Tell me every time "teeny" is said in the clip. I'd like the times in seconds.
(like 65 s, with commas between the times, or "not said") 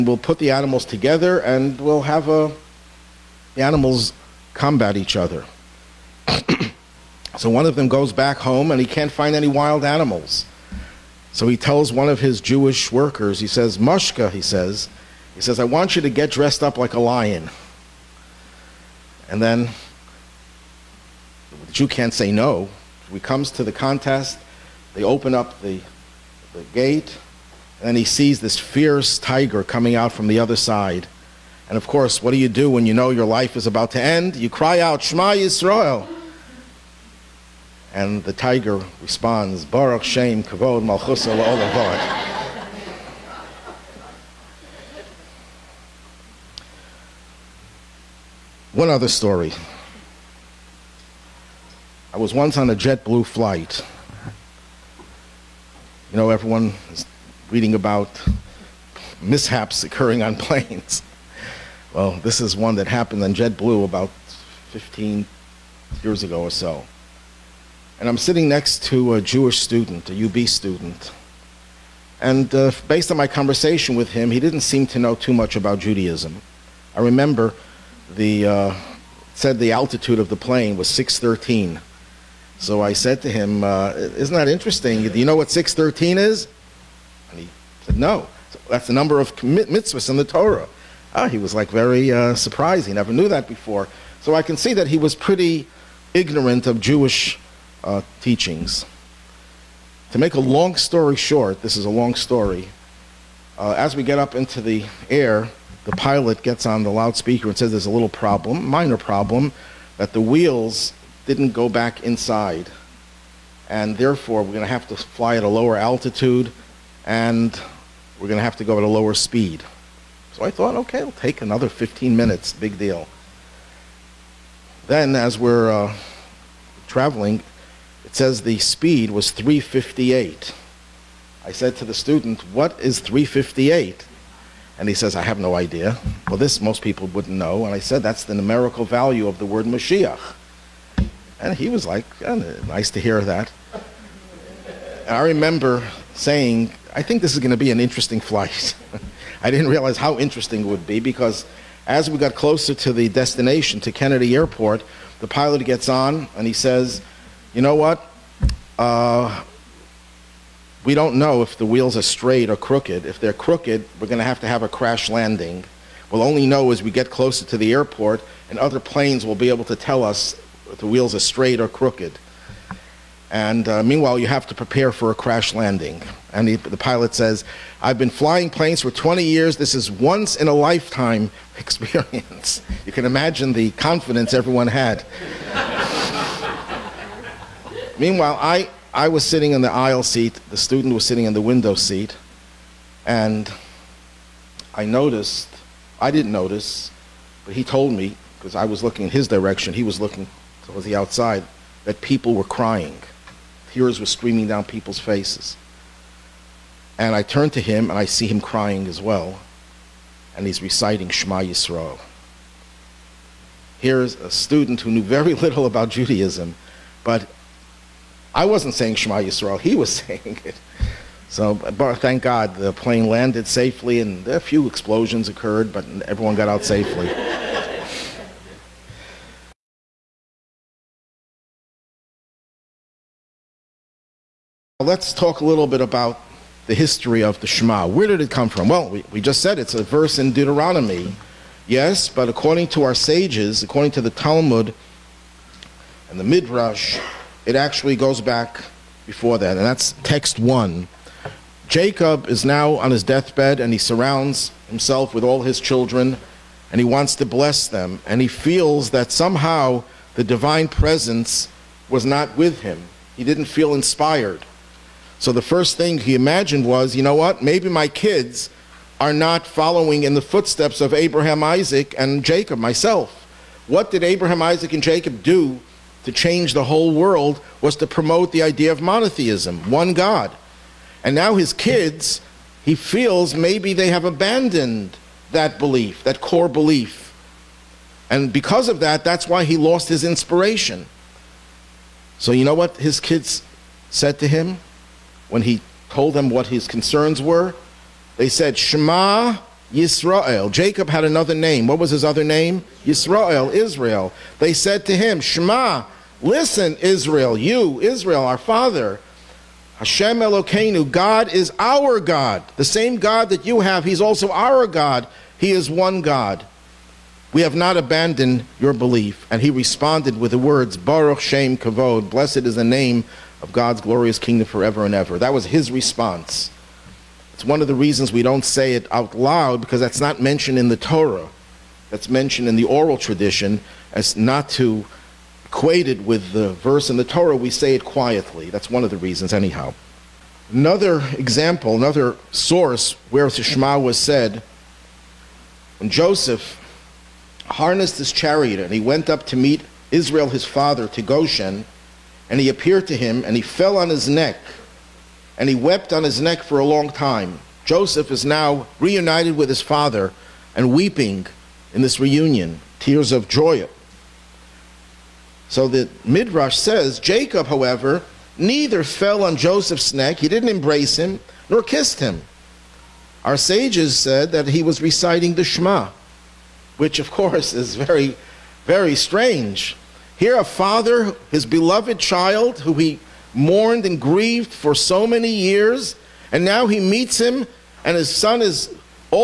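not said.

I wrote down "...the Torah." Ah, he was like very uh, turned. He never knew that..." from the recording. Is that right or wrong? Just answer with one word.
wrong.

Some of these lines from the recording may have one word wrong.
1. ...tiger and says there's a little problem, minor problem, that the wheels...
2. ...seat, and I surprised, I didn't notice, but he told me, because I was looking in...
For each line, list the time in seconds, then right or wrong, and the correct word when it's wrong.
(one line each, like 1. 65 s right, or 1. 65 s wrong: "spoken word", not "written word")
1. 106 s wrong: "loudspeaker", not "tiger"
2. 191 s wrong: "noticed", not "surprised".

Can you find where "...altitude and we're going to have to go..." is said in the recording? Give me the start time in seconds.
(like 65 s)
115 s.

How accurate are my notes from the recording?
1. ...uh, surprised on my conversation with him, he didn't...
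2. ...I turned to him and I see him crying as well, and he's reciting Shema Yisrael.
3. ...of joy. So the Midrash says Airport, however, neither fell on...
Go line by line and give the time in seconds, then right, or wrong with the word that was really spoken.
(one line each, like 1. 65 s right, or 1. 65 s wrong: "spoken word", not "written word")
1. 72 s wrong: "based", not "surprised"
2. 207 s right
3. 363 s wrong: "Jacob", not "Airport".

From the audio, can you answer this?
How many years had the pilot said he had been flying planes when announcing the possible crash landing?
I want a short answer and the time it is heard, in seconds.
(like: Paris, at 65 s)
20, at 178 s.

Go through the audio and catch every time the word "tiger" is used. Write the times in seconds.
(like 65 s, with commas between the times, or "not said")
29 s, 38 s.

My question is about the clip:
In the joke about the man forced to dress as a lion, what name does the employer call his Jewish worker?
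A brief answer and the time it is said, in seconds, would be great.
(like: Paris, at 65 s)
Mushka, at 13 s.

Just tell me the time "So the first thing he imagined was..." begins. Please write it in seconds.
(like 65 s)
265 s.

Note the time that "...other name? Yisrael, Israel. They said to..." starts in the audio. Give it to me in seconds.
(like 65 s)
302 s.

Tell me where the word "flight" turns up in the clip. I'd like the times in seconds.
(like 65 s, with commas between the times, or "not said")
53 s, 148 s.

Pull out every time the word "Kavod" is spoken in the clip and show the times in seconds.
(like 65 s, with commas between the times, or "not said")
40 s, 321 s.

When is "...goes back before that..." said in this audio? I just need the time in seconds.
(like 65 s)
247 s.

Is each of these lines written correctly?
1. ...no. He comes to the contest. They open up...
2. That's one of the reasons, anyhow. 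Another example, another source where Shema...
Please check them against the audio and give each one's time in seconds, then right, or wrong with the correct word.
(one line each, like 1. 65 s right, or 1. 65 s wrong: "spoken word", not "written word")
1. 22 s right
2. 338 s right.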